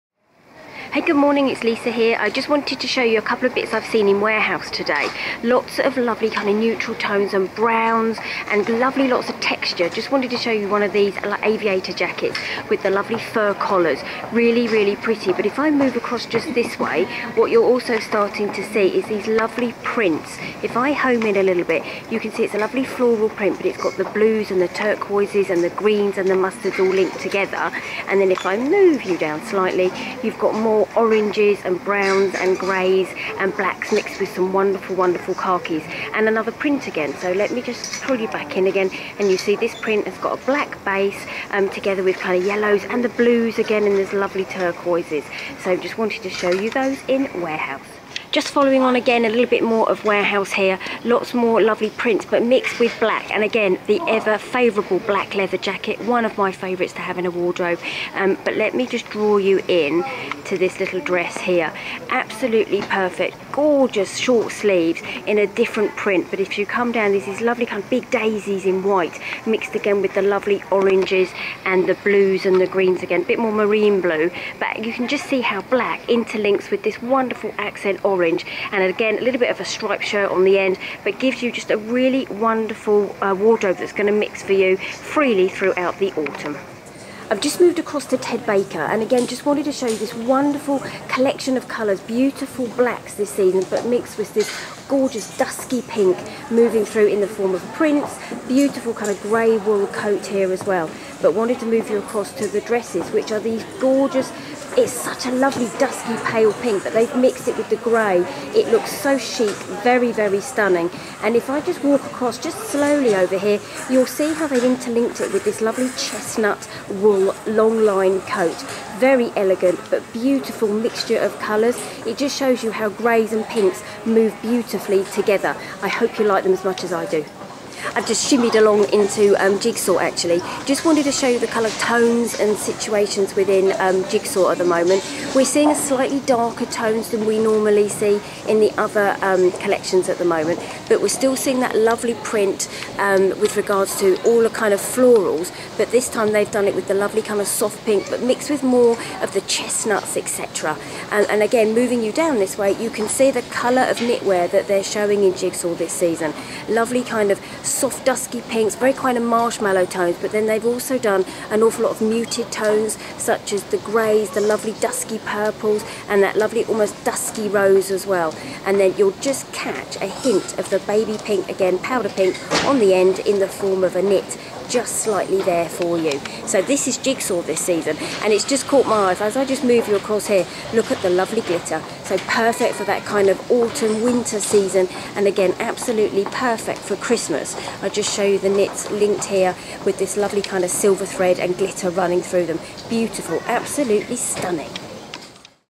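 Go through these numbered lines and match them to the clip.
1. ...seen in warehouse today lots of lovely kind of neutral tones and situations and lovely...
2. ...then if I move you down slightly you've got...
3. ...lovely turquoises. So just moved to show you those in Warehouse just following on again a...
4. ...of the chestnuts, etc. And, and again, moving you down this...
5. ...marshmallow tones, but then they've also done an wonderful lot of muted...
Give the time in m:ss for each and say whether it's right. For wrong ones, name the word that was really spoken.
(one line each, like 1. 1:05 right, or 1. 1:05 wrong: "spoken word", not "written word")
1. 0:03 wrong: "browns", not "situations"
2. 0:28 right
3. 0:44 wrong: "wanted", not "moved"
4. 2:29 right
5. 2:39 wrong: "awful", not "wonderful".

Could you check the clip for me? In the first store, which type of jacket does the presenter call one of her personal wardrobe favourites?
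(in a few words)
Black leather jacket.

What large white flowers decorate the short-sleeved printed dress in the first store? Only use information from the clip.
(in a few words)
Daisies.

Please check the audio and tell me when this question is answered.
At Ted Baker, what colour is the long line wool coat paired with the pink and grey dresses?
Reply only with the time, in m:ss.
1:55.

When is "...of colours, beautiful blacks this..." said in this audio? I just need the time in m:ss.
1:31.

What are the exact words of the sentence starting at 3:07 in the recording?
I just show you the knits linked here with this lovely kind of silver thread and glitter running through them.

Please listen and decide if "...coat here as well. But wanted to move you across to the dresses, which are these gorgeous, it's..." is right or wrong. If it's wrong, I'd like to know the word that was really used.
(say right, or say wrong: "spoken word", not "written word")
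right.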